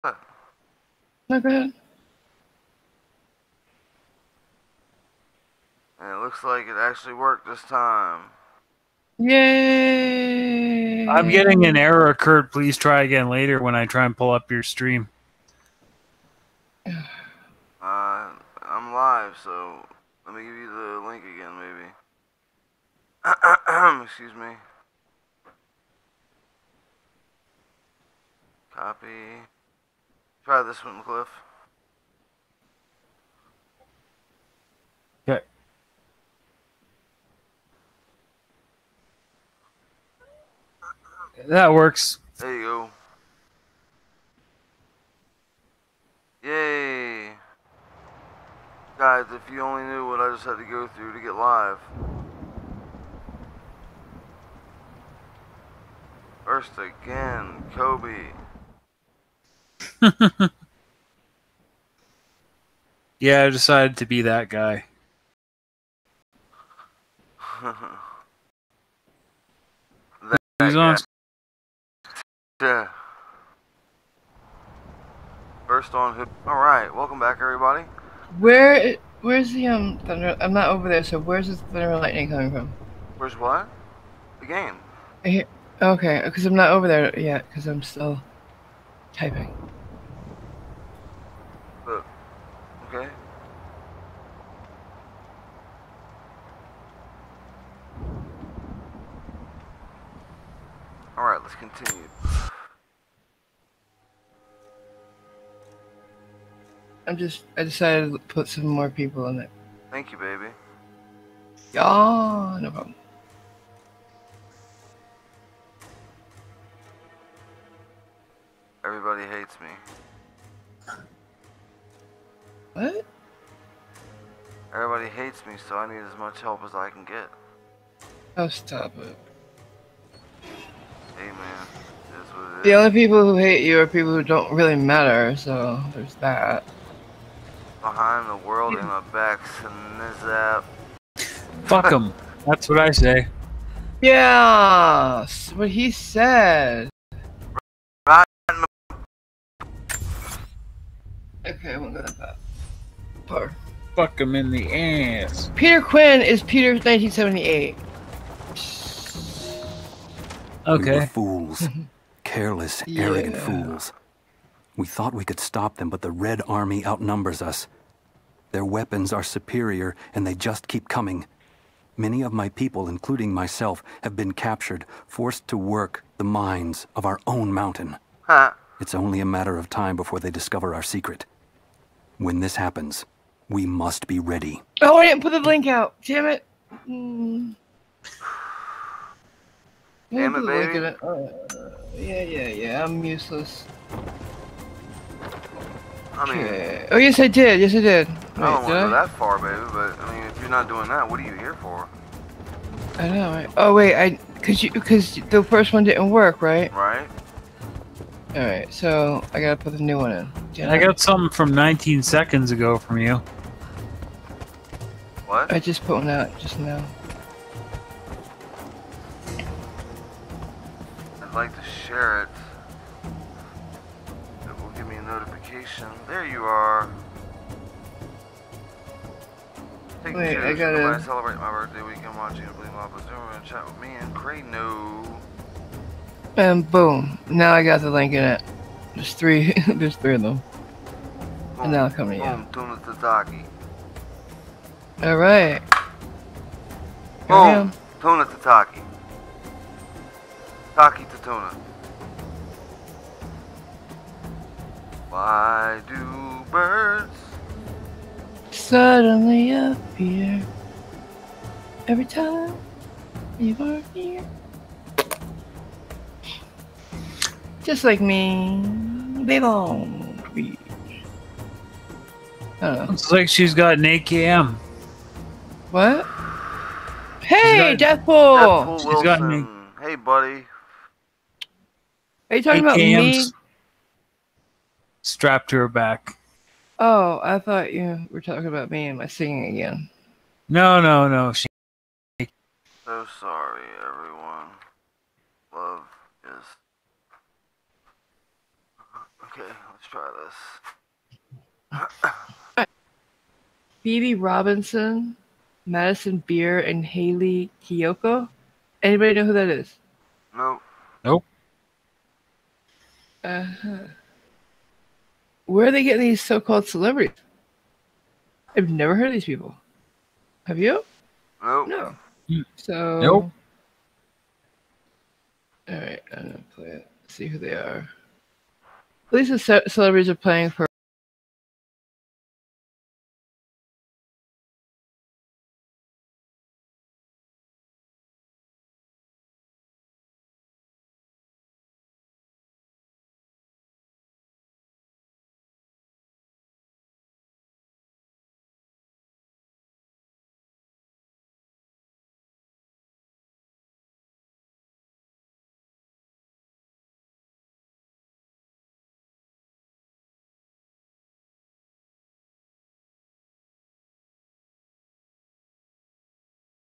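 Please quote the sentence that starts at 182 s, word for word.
When this happens, we must be ready.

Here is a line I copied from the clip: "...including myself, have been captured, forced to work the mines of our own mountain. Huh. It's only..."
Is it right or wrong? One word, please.
right.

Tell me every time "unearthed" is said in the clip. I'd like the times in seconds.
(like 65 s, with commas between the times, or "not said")
not said.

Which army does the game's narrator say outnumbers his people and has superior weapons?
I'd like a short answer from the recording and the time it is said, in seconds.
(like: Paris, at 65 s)
Red Army, at 166 s.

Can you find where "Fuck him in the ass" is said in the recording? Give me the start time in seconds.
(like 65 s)
153 s.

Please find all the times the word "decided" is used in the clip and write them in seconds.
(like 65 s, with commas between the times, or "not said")
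63 s, 107 s.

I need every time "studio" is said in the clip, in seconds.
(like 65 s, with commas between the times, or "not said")
not said.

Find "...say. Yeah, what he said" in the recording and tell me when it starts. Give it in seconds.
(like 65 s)
142 s.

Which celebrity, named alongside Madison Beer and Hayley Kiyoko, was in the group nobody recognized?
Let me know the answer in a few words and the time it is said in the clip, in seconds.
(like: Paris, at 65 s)
Phoebe Robinson, at 303 s.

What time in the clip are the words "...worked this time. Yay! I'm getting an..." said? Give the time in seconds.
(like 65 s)
7 s.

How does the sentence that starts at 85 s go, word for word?
Hear, okay, because I'm not over there yet, because I'm still typing okay.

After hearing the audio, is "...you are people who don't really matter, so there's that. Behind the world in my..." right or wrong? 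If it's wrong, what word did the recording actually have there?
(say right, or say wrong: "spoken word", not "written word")
right.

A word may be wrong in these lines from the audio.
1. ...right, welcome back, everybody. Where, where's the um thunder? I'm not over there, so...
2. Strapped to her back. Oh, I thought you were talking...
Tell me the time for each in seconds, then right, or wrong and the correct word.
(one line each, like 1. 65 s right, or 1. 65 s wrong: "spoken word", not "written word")
1. 76 s right
2. 285 s right.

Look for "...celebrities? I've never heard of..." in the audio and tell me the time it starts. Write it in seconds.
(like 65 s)
316 s.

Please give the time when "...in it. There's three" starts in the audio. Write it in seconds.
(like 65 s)
238 s.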